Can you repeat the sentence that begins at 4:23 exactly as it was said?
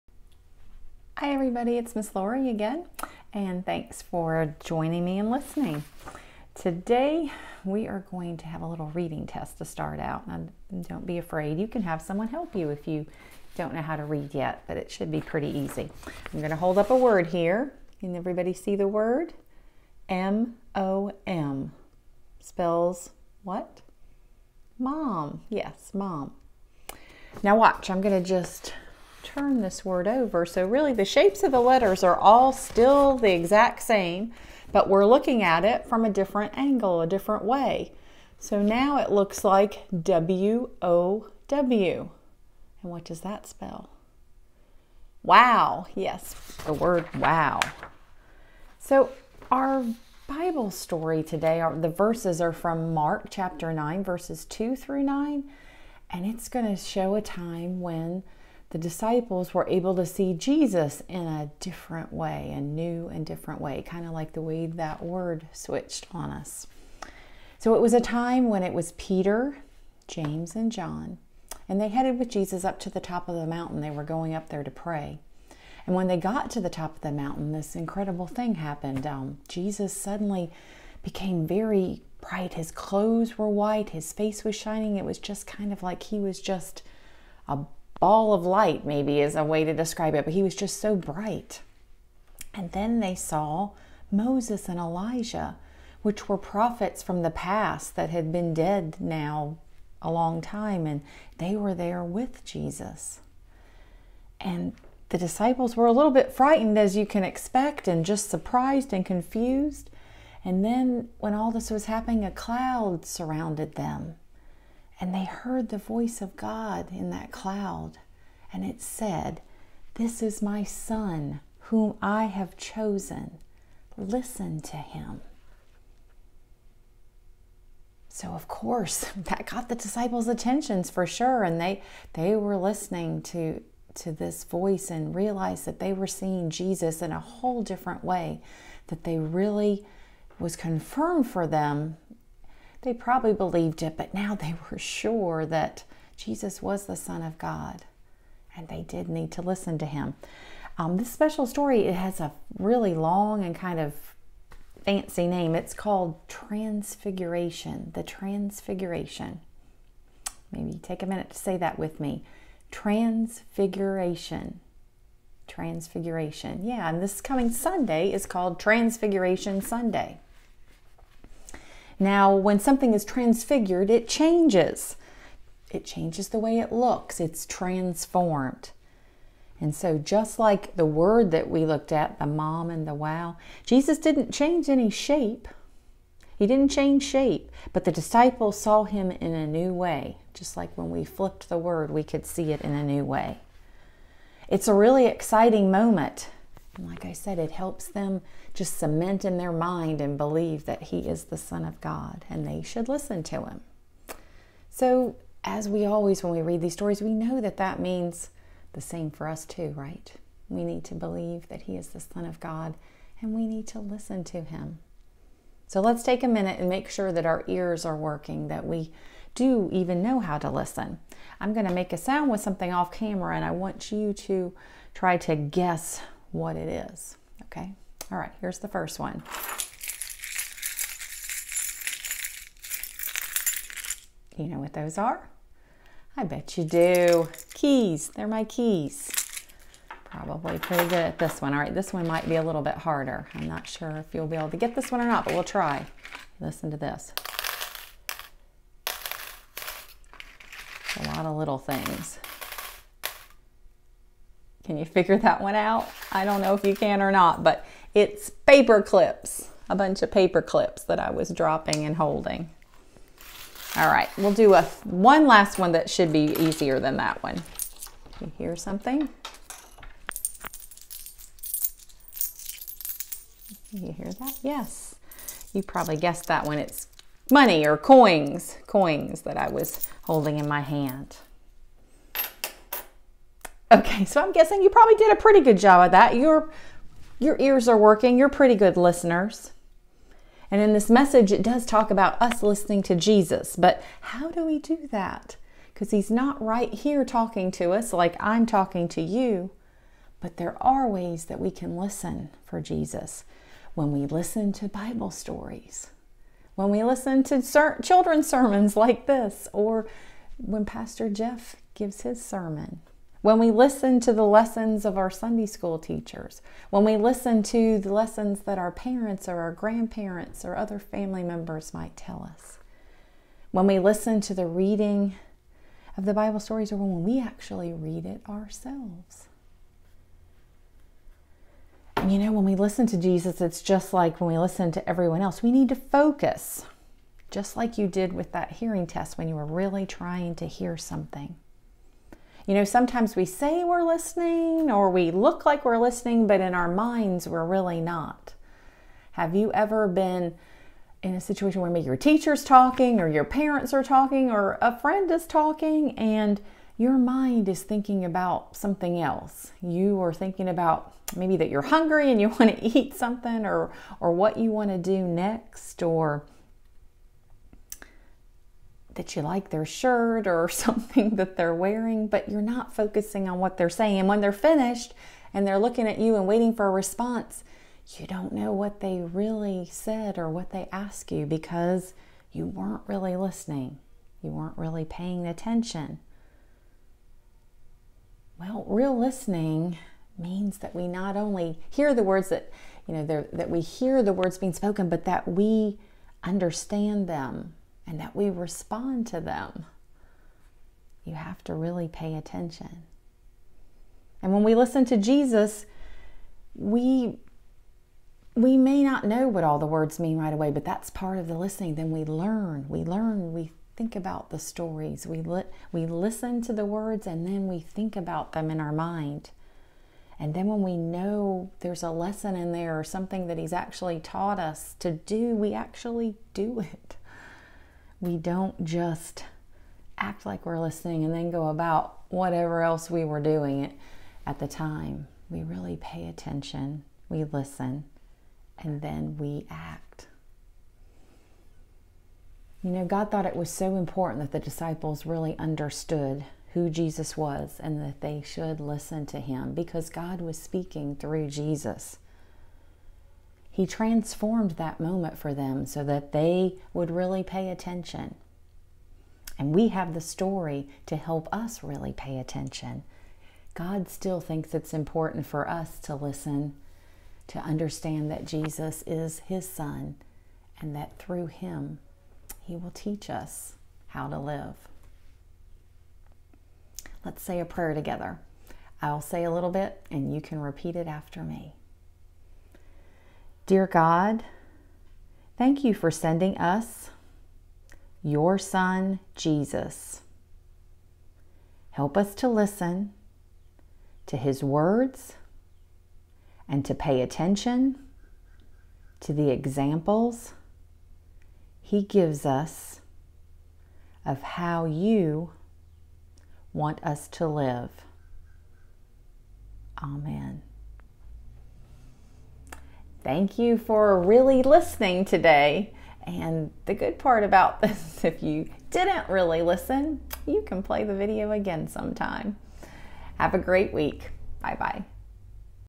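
All right, we'll do a one last one that should be easier than that one.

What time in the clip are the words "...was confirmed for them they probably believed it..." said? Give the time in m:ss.
2:20.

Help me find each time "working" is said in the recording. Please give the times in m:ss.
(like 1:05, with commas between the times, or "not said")
3:37, 4:47.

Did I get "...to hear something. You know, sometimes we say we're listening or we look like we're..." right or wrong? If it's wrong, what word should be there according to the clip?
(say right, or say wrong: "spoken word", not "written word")
right.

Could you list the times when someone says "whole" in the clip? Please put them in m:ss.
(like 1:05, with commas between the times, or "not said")
2:17.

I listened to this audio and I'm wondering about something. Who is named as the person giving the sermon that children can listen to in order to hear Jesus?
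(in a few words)
Pastor Jeff.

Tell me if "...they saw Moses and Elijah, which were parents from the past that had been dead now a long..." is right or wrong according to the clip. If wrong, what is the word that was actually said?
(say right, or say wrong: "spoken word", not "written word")
wrong: "prophets", not "parents".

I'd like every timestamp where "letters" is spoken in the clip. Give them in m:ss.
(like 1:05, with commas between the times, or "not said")
0:31.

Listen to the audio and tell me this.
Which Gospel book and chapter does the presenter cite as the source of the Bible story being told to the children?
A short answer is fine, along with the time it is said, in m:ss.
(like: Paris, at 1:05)
Mark chapter 9, at 0:52.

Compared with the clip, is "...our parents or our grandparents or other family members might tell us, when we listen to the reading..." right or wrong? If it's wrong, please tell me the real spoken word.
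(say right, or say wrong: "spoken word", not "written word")
right.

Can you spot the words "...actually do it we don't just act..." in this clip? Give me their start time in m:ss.
7:05.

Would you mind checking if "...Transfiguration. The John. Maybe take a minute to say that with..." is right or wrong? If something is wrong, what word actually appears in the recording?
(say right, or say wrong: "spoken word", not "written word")
wrong: "Transfiguration", not "John".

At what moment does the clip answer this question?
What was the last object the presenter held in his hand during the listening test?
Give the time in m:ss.
4:38.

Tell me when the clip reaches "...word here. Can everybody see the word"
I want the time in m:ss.
0:16.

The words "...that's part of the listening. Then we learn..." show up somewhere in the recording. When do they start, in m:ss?
6:50.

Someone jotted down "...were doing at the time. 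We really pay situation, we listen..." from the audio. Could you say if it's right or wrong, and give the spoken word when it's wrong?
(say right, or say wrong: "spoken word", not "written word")
wrong: "attention", not "situation".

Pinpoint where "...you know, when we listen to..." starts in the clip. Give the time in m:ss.
5:32.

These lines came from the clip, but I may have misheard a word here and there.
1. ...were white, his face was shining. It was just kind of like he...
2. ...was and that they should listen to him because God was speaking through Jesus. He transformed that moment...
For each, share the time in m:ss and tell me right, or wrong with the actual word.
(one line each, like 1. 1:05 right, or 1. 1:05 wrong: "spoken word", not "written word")
1. 1:23 right
2. 7:27 right.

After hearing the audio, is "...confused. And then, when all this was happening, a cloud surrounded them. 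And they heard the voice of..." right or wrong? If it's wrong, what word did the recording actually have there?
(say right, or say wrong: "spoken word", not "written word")
right.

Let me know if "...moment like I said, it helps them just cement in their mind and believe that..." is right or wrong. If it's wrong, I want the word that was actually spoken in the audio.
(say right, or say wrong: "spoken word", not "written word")
right.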